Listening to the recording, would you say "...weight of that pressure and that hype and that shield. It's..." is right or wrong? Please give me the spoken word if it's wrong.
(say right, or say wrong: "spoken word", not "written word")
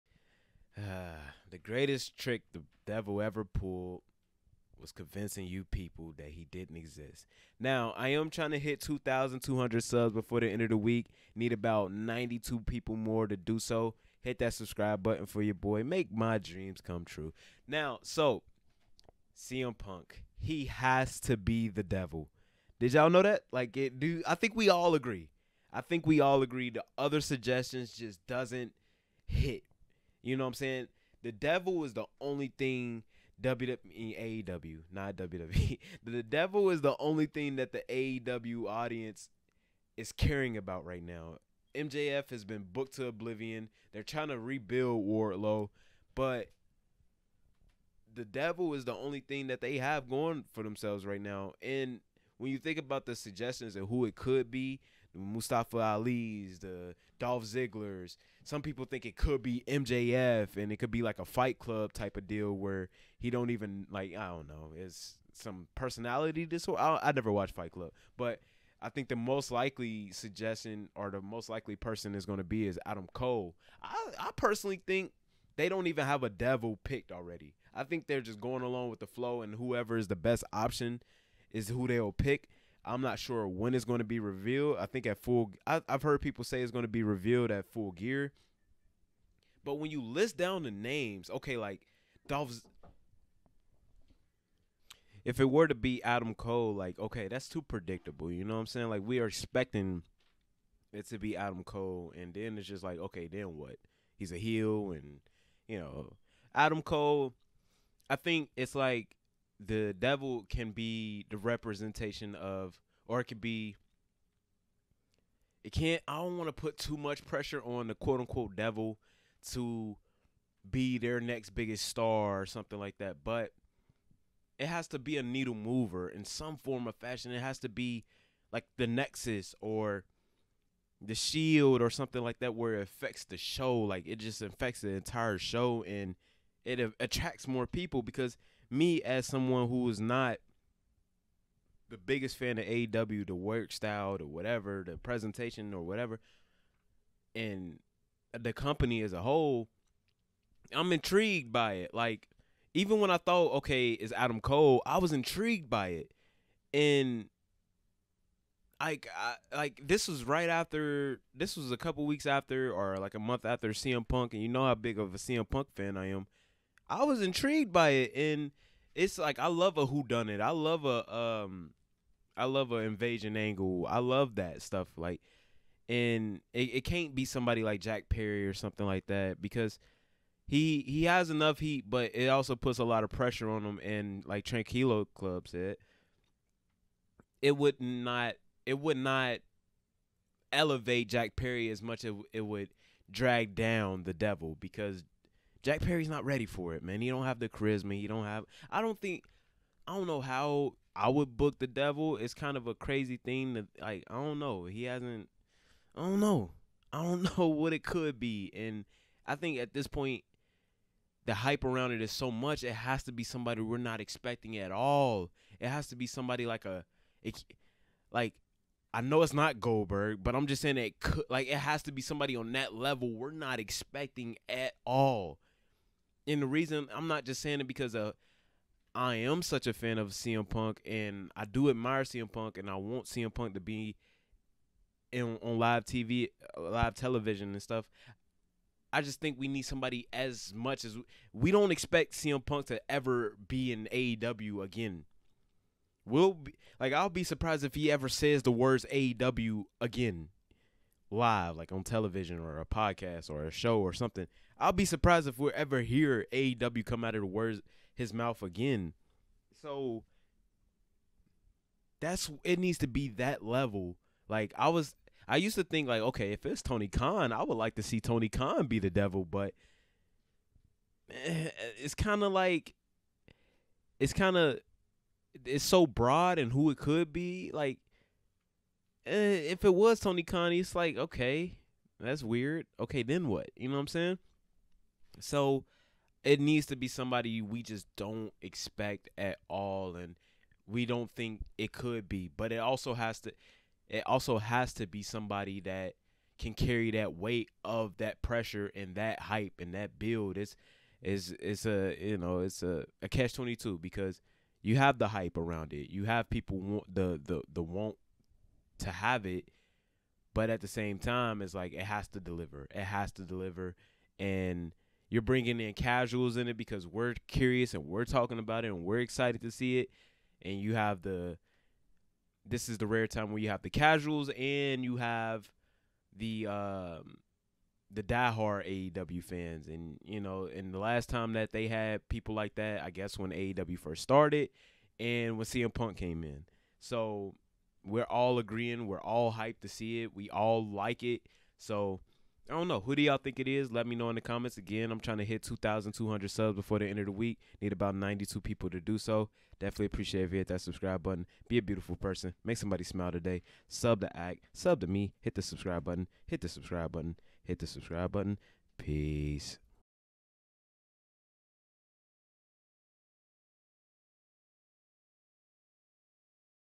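wrong: "build", not "shield".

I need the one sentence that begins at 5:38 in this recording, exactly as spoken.
We're all hyped to see it.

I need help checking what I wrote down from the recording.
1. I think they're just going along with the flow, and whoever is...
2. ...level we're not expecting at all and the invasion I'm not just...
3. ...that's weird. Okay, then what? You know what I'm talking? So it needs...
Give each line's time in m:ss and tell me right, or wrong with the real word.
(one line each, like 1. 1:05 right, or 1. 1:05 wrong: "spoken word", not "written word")
1. 1:17 right
2. 3:42 wrong: "reason", not "invasion"
3. 4:41 wrong: "saying", not "talking".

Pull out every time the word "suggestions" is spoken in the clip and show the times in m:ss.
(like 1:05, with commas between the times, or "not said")
0:27, 0:53, 1:10.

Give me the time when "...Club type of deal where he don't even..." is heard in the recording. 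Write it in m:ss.
1:01.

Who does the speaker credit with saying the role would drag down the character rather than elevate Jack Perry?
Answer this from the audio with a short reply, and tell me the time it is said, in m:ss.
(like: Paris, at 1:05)
Tranquilo Club, at 3:04.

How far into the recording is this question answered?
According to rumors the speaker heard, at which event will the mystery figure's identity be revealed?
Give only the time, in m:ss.
1:27.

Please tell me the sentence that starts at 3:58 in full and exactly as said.
I just think we need somebody as much as we, we don't expect CM Punk to ever be in AEW again.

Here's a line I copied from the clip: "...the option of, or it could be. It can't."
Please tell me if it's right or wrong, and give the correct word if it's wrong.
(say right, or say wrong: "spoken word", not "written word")
wrong: "representation", not "option".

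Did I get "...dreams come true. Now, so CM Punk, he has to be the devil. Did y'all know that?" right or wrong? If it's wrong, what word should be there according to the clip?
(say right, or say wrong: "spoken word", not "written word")
right.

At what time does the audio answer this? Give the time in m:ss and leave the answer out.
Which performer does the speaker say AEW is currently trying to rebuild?
0:45.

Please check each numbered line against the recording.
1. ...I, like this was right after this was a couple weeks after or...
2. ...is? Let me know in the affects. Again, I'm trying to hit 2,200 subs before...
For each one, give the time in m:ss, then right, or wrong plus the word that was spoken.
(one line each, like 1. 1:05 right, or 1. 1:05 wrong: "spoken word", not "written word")
1. 2:39 right
2. 5:43 wrong: "comments", not "affects".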